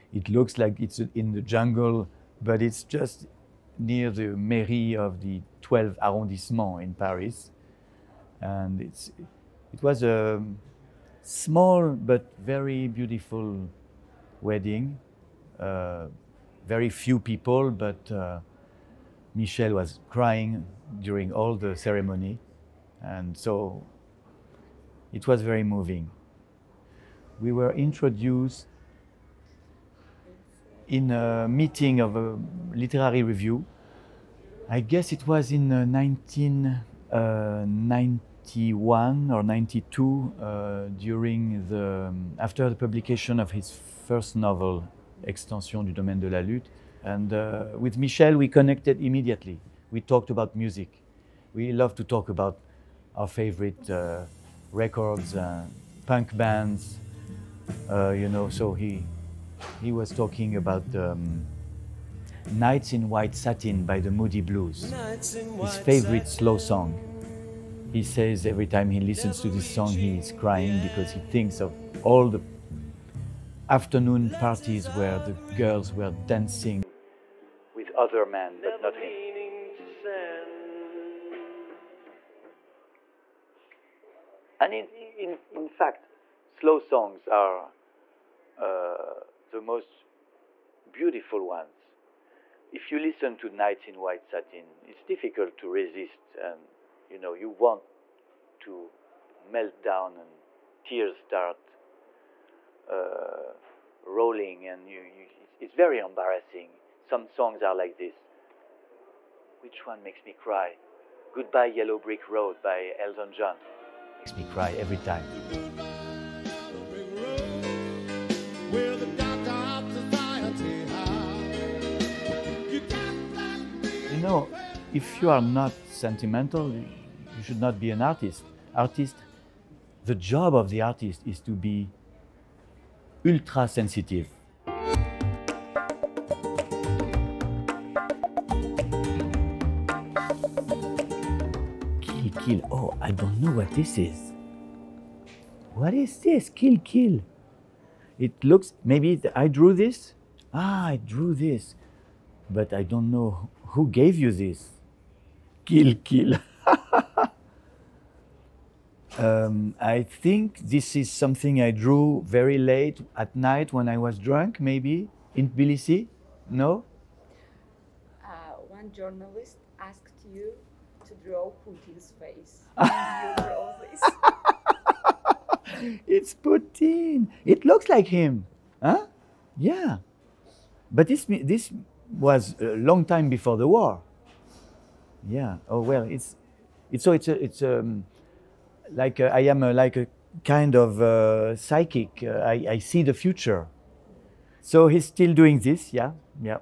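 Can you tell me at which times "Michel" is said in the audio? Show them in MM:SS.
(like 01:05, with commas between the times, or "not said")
00:19, 00:47.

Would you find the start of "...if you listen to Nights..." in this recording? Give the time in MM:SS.
01:32.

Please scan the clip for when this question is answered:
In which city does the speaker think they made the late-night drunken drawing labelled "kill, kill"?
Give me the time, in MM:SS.
02:45.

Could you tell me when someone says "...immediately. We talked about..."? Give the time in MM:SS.
00:49.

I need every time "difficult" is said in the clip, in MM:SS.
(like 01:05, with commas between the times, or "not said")
01:35.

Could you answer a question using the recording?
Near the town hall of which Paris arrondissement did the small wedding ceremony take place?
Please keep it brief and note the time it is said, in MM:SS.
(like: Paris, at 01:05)
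12th arrondissement, at 00:05.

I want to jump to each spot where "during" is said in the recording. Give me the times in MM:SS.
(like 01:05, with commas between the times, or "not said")
00:21, 00:40.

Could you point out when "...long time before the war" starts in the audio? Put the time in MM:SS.
03:02.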